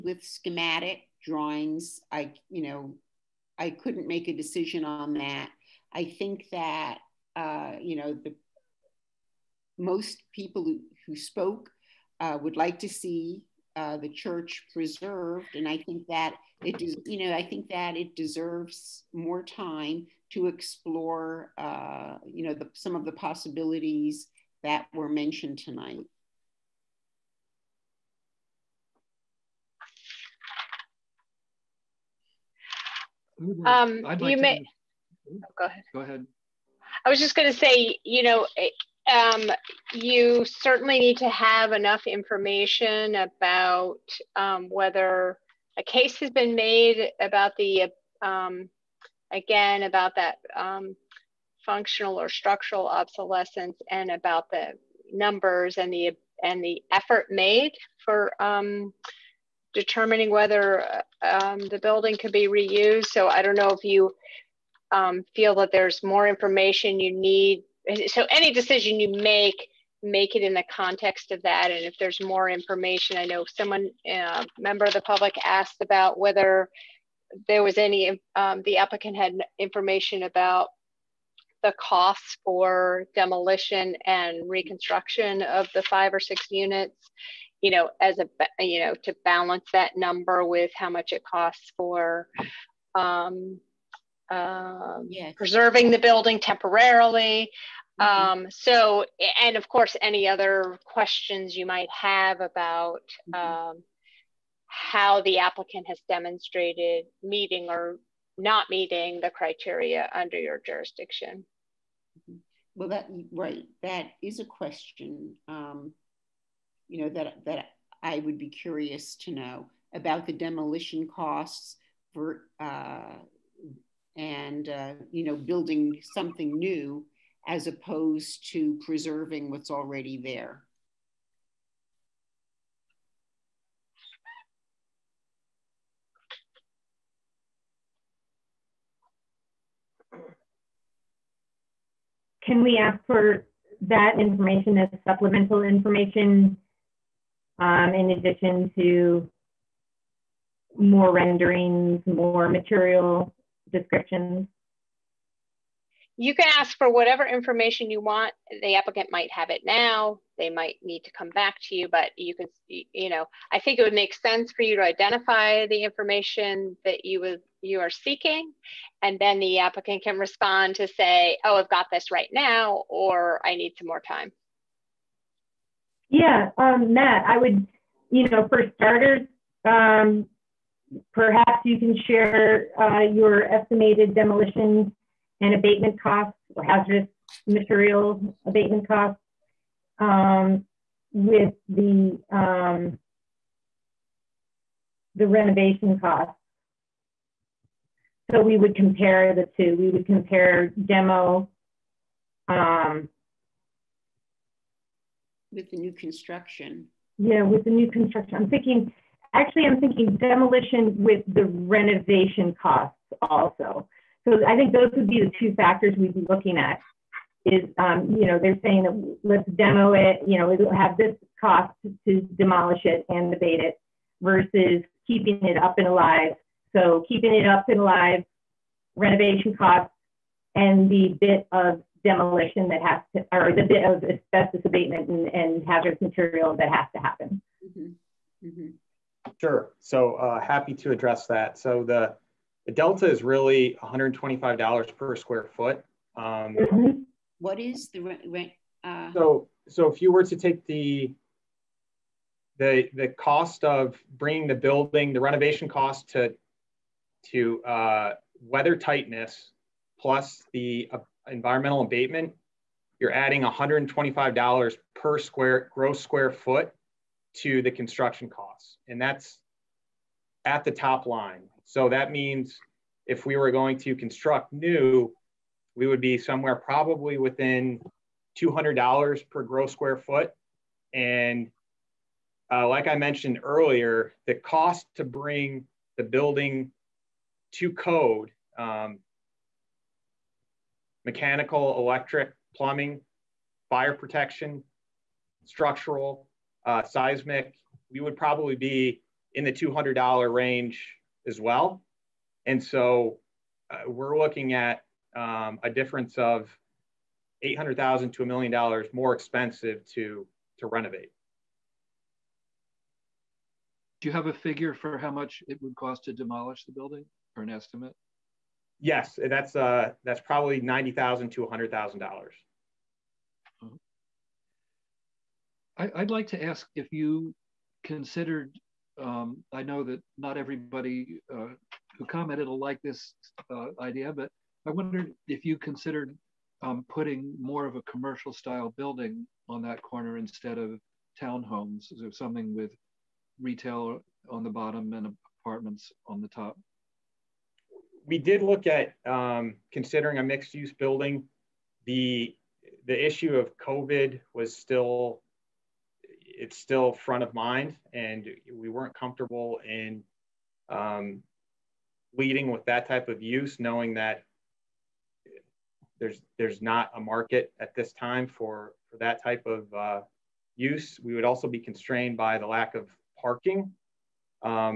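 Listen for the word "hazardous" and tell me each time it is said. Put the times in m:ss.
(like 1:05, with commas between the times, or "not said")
3:06, 3:55.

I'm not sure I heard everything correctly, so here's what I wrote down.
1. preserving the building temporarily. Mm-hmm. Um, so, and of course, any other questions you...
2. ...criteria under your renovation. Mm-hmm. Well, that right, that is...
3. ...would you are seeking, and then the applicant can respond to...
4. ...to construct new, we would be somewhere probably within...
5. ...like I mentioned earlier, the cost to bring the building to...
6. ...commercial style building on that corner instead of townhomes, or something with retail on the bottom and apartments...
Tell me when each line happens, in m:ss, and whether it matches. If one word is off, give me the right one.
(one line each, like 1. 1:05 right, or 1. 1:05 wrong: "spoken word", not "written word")
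1. 1:35 right
2. 1:49 wrong: "jurisdiction", not "renovation"
3. 2:47 right
4. 4:33 right
5. 4:42 right
6. 5:37 right.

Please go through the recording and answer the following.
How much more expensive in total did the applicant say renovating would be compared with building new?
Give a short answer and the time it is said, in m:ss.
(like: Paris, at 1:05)
800,000 to 1,000,000 dollars, at 5:07.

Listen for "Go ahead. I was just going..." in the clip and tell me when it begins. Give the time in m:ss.
0:35.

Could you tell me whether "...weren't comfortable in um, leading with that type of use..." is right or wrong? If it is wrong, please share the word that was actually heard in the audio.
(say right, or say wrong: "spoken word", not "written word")
right.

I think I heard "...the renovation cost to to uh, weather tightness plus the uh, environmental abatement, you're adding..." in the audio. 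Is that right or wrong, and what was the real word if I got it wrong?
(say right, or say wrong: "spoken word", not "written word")
right.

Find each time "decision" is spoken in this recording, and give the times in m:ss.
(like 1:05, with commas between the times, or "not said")
0:04, 1:08.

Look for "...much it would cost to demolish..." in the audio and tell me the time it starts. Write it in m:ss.
5:15.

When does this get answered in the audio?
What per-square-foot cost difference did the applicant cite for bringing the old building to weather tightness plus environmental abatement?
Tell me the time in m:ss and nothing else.
4:03.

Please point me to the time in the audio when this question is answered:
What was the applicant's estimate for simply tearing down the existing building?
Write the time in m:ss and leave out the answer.
5:20.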